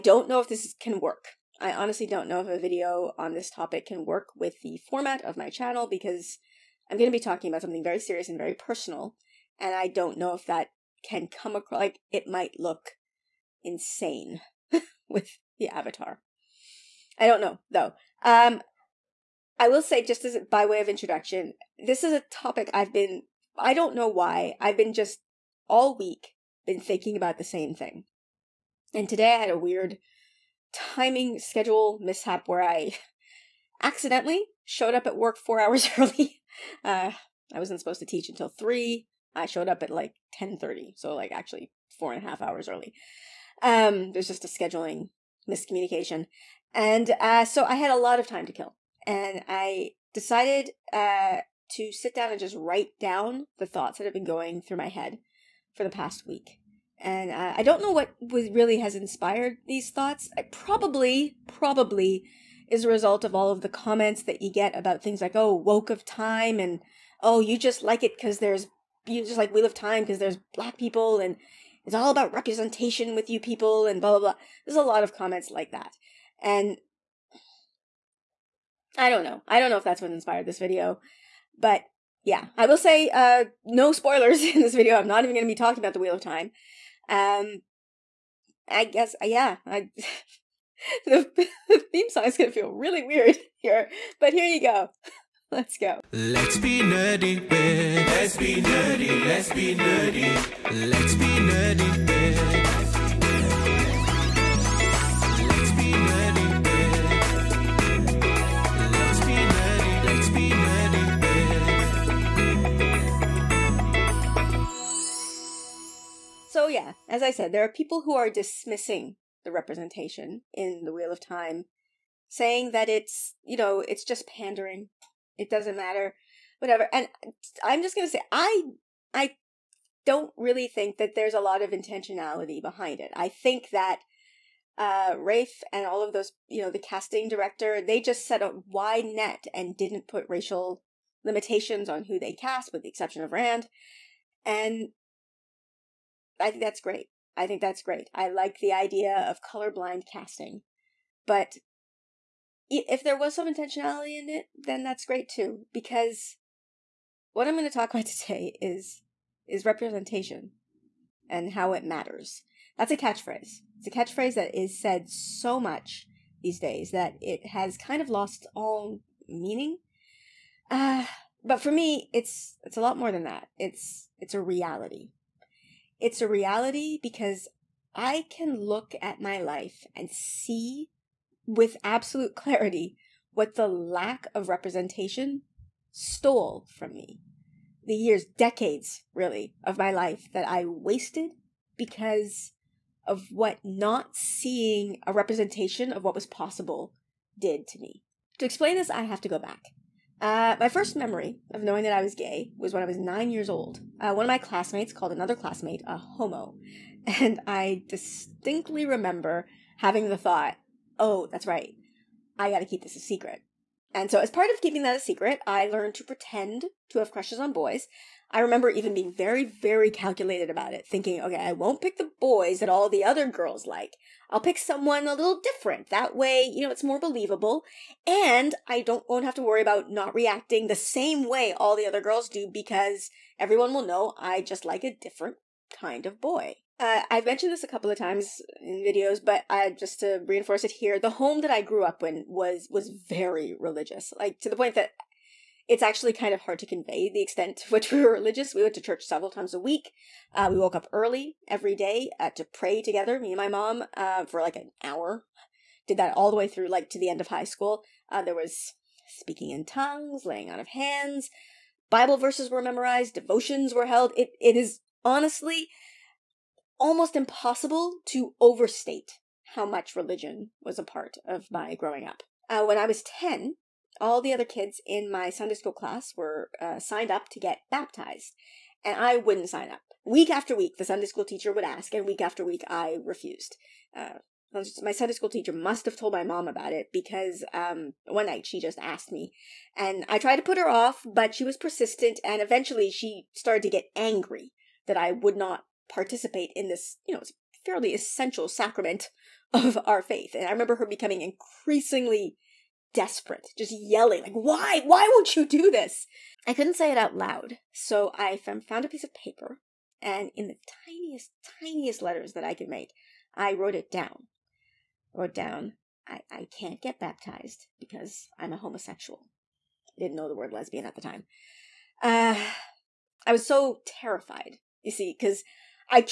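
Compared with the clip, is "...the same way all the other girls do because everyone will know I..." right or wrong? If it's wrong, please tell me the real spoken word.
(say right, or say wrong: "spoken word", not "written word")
right.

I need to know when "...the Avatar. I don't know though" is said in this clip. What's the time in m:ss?
0:15.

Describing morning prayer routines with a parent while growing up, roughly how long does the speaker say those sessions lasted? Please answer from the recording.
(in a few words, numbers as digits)
an hour.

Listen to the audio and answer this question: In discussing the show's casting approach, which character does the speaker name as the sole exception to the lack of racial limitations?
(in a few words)
Rand.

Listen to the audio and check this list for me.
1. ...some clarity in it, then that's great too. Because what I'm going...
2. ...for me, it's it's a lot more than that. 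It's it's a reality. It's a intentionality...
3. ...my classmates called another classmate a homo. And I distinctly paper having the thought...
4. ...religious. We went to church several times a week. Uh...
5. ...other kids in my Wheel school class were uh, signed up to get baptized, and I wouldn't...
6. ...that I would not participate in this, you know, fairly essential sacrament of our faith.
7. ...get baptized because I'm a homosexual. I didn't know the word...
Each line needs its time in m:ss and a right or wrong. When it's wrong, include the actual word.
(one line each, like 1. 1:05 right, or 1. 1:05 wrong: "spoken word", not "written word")
1. 2:33 wrong: "intentionality", not "clarity"
2. 2:51 wrong: "reality", not "intentionality"
3. 3:24 wrong: "remember", not "paper"
4. 4:08 right
5. 4:34 wrong: "Sunday", not "Wheel"
6. 4:54 right
7. 5:16 right.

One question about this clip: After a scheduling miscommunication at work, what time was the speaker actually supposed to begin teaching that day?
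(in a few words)
3.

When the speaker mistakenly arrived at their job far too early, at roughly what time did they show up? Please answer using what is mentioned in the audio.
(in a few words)
10:30.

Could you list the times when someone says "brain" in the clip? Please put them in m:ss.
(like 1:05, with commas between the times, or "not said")
not said.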